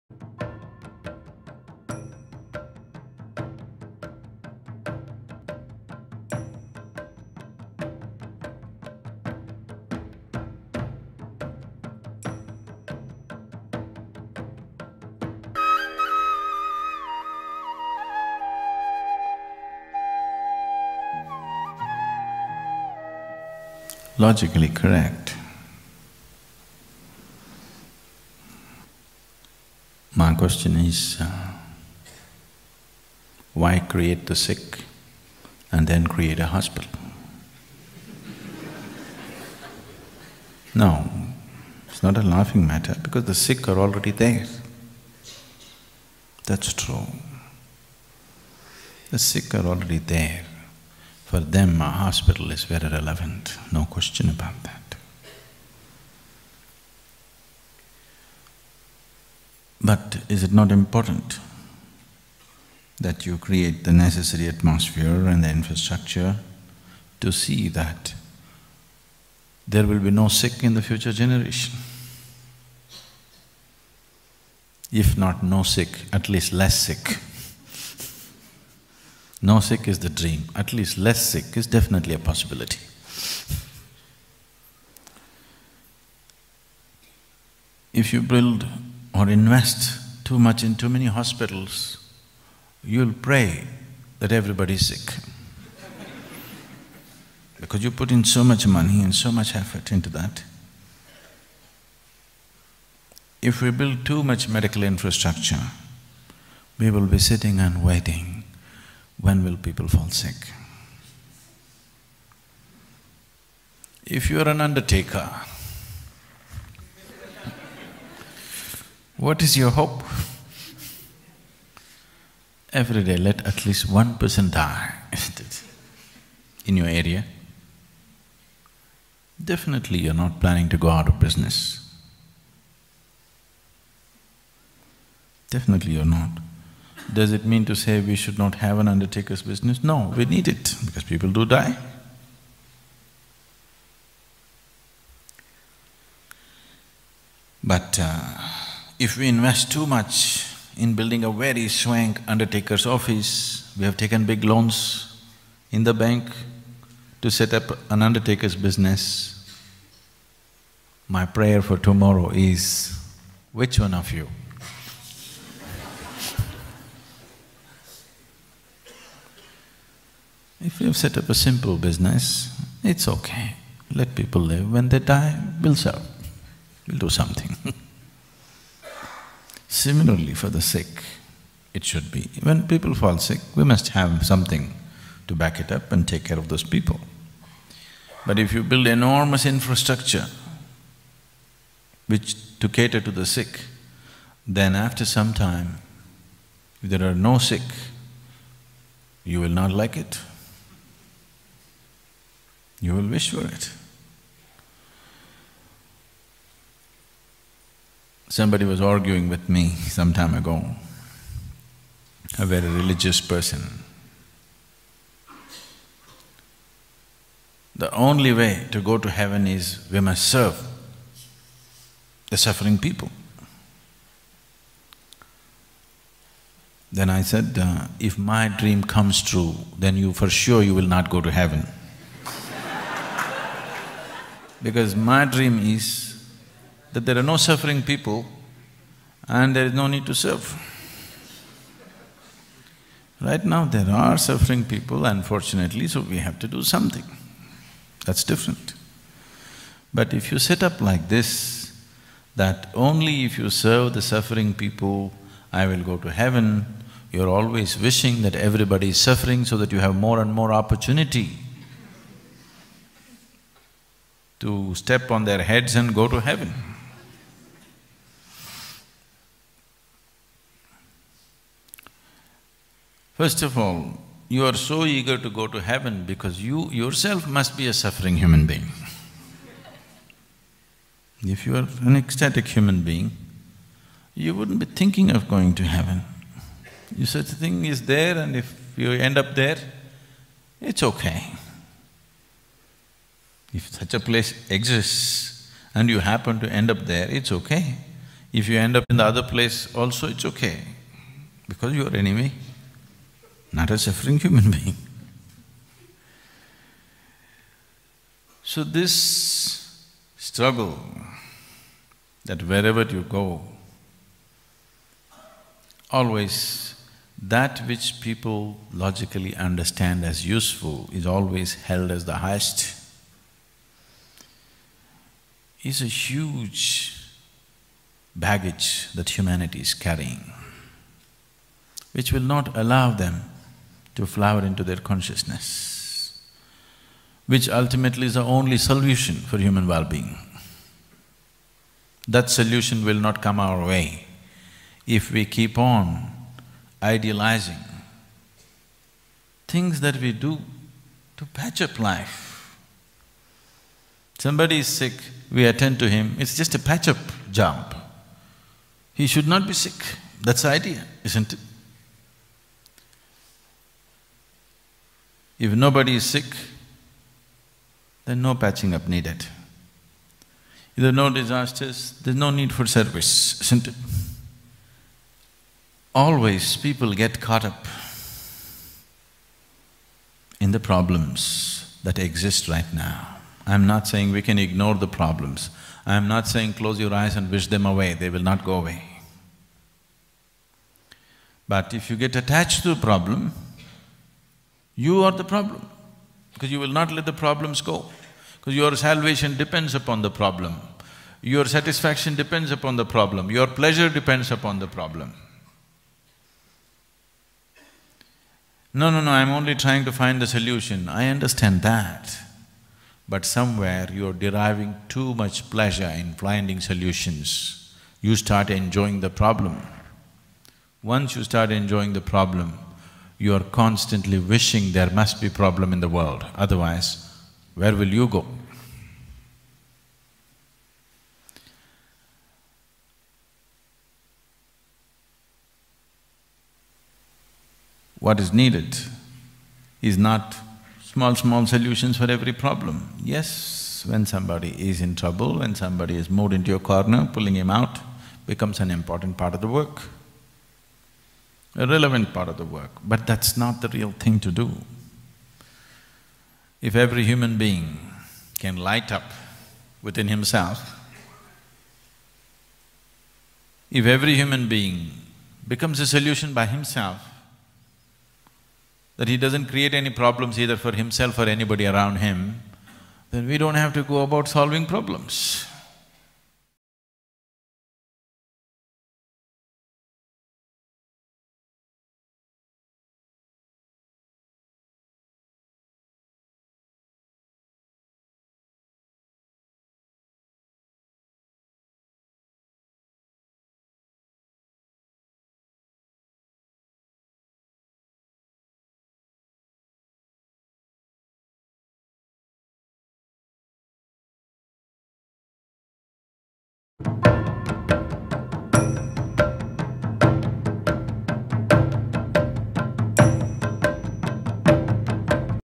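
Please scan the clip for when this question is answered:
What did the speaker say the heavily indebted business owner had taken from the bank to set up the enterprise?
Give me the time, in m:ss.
2:34.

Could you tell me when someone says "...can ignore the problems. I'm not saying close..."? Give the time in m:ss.
6:24.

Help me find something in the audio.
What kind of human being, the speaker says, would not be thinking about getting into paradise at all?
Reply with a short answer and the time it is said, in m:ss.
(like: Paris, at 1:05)
An ecstatic human being, at 4:41.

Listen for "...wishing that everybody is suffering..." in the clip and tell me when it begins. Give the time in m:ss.
4:17.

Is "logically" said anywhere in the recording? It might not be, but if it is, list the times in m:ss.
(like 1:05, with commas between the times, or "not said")
0:24, 5:18.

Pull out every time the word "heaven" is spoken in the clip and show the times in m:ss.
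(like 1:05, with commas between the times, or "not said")
3:39, 3:51, 4:16, 4:26, 4:35, 4:45.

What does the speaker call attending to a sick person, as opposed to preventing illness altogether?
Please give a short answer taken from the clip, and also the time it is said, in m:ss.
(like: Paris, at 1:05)
Patch-up job, at 5:56.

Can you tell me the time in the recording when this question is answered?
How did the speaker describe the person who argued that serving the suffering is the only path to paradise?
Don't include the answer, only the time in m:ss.
3:32.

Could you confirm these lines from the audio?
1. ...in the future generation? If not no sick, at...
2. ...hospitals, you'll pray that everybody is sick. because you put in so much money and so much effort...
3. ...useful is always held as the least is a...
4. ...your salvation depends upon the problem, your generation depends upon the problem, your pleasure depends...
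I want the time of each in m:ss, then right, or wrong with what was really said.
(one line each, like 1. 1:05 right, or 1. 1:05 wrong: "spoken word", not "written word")
1. 1:10 right
2. 1:31 right
3. 5:20 wrong: "highest", not "least"
4. 6:38 wrong: "satisfaction", not "generation".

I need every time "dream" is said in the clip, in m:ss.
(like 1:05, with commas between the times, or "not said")
1:20, 3:48, 3:55.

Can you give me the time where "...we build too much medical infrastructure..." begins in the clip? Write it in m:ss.
1:43.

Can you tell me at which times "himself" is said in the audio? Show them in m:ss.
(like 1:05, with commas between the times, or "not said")
7:40, 7:46, 7:50.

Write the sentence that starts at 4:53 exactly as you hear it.
If such a place exists and you happen to end up there, it's okay.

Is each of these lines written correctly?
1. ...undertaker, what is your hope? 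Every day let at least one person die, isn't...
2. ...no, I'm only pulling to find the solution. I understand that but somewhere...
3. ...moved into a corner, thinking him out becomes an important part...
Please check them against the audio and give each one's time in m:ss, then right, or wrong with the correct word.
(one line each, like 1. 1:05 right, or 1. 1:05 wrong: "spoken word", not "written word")
1. 1:54 right
2. 6:49 wrong: "trying", not "pulling"
3. 7:26 wrong: "pulling", not "thinking".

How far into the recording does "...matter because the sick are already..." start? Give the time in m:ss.
0:42.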